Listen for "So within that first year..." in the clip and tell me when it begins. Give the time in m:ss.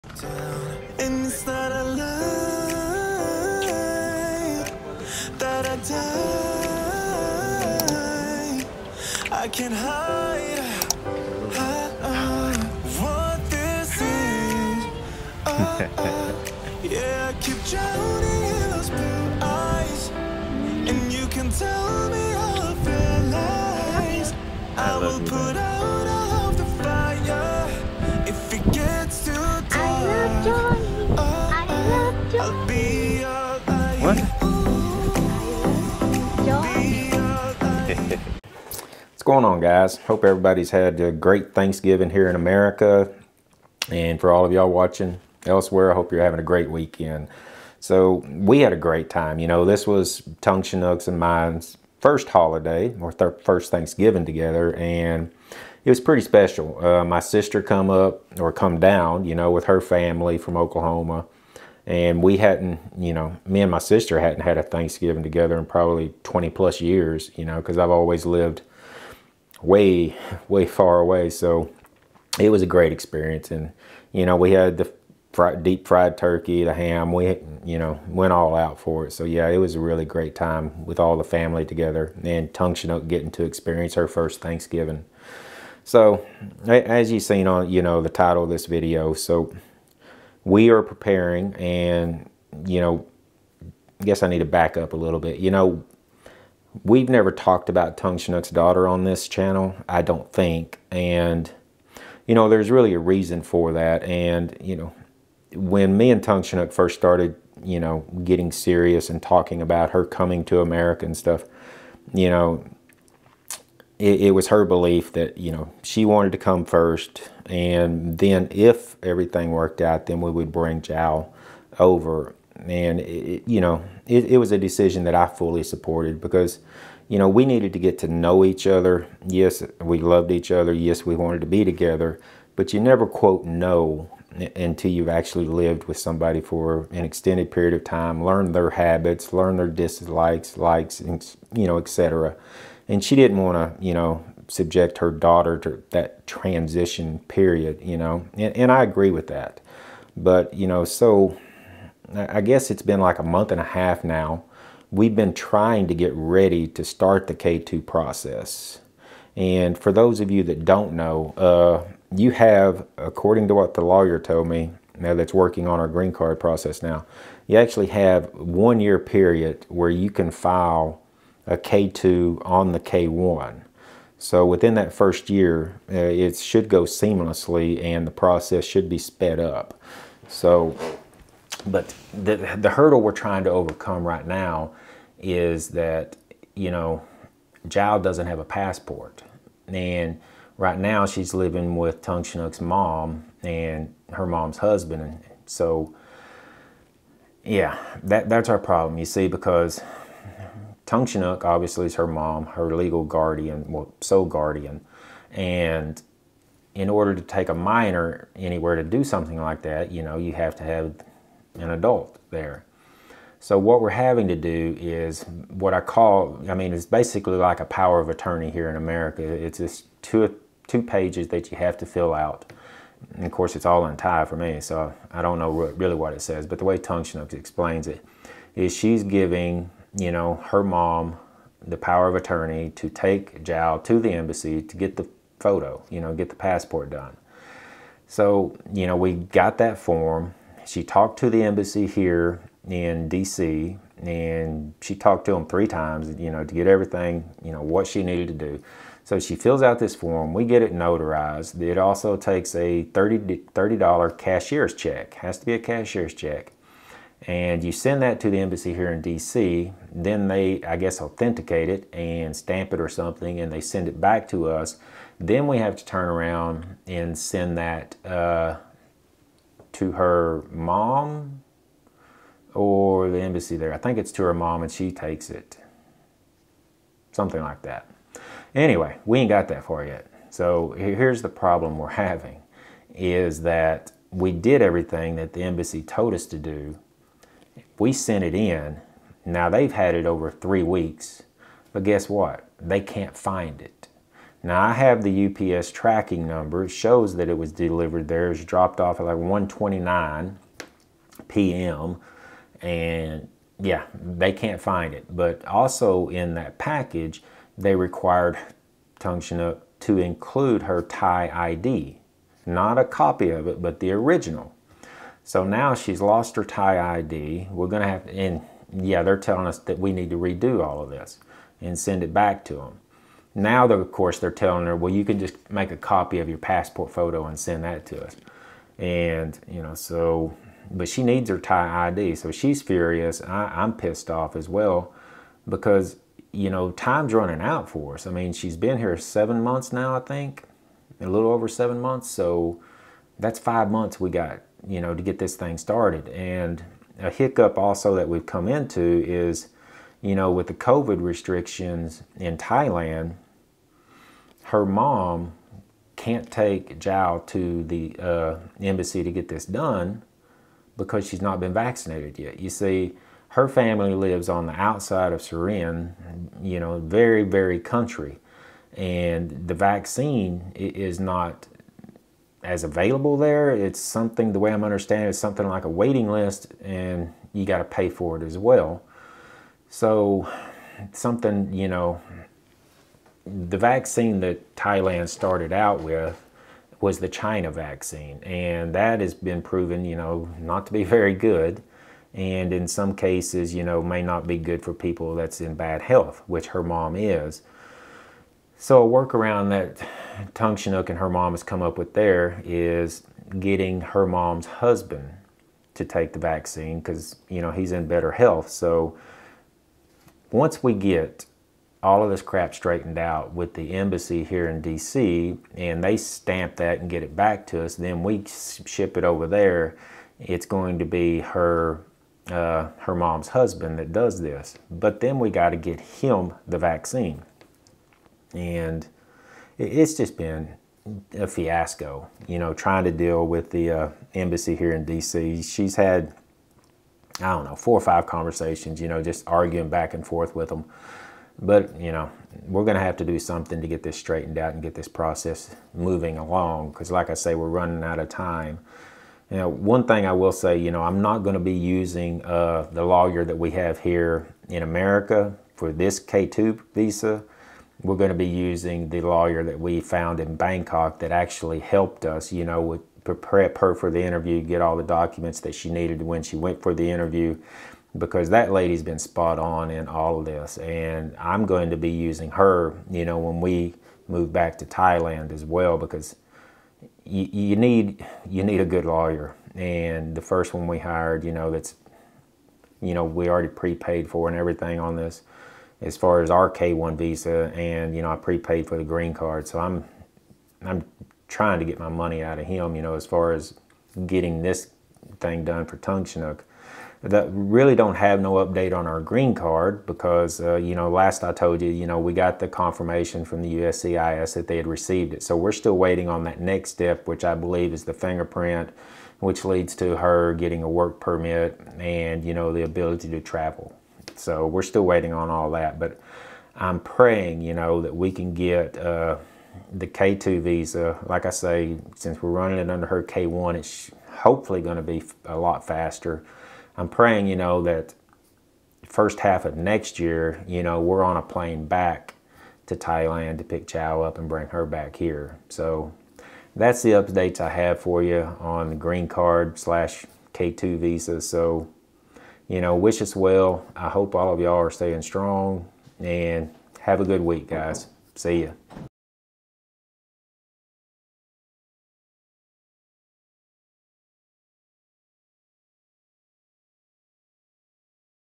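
2:54.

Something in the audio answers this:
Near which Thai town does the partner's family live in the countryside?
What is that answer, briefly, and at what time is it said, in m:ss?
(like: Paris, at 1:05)
Surin, at 6:05.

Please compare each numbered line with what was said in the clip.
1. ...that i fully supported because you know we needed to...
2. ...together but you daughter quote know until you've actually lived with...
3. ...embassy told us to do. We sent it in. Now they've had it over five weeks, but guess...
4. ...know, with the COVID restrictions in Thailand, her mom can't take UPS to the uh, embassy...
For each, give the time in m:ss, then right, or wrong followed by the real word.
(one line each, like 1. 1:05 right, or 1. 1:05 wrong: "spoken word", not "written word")
1. 2:05 right
2. 2:11 wrong: "never", not "daughter"
3. 4:45 wrong: "three", not "five"
4. 5:50 wrong: "Jao", not "UPS".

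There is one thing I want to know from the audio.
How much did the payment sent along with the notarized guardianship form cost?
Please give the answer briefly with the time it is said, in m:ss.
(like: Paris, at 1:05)
$30, at 4:12.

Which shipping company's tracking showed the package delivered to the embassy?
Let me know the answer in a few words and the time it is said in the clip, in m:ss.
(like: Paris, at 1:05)
UPS, at 4:55.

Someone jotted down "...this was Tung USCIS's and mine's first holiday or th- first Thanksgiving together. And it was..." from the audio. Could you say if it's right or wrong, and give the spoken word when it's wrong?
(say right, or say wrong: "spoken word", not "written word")
wrong: "Chinook", not "USCIS".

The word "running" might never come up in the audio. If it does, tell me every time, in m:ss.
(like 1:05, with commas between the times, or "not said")
5:37, 7:27, 8:42.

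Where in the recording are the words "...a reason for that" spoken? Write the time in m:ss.
1:42.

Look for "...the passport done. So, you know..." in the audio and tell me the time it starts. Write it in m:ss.
3:56.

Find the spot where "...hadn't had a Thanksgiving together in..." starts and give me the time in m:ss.
1:04.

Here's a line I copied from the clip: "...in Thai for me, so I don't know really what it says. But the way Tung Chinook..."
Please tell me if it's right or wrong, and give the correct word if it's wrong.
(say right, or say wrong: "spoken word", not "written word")
right.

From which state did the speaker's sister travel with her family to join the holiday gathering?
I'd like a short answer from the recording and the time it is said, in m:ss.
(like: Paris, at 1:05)
Oklahoma, at 1:00.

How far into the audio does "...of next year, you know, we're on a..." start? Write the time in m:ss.
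8:49.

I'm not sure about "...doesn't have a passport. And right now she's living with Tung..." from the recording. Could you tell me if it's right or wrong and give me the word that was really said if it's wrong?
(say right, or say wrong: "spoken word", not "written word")
right.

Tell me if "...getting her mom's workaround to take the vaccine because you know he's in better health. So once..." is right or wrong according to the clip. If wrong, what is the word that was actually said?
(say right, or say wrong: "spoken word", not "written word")
wrong: "husband", not "workaround".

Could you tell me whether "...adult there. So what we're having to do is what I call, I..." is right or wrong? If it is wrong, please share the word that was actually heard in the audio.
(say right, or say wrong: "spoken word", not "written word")
right.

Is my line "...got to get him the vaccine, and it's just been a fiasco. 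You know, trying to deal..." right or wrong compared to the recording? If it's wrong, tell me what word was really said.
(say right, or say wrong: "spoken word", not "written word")
right.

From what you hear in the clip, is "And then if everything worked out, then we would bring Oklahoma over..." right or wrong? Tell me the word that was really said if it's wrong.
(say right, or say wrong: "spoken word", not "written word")
wrong: "Jao", not "Oklahoma".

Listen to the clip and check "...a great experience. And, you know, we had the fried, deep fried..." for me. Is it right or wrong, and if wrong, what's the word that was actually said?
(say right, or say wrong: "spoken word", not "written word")
right.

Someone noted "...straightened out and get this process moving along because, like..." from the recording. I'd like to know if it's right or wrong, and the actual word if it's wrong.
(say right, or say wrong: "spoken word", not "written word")
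right.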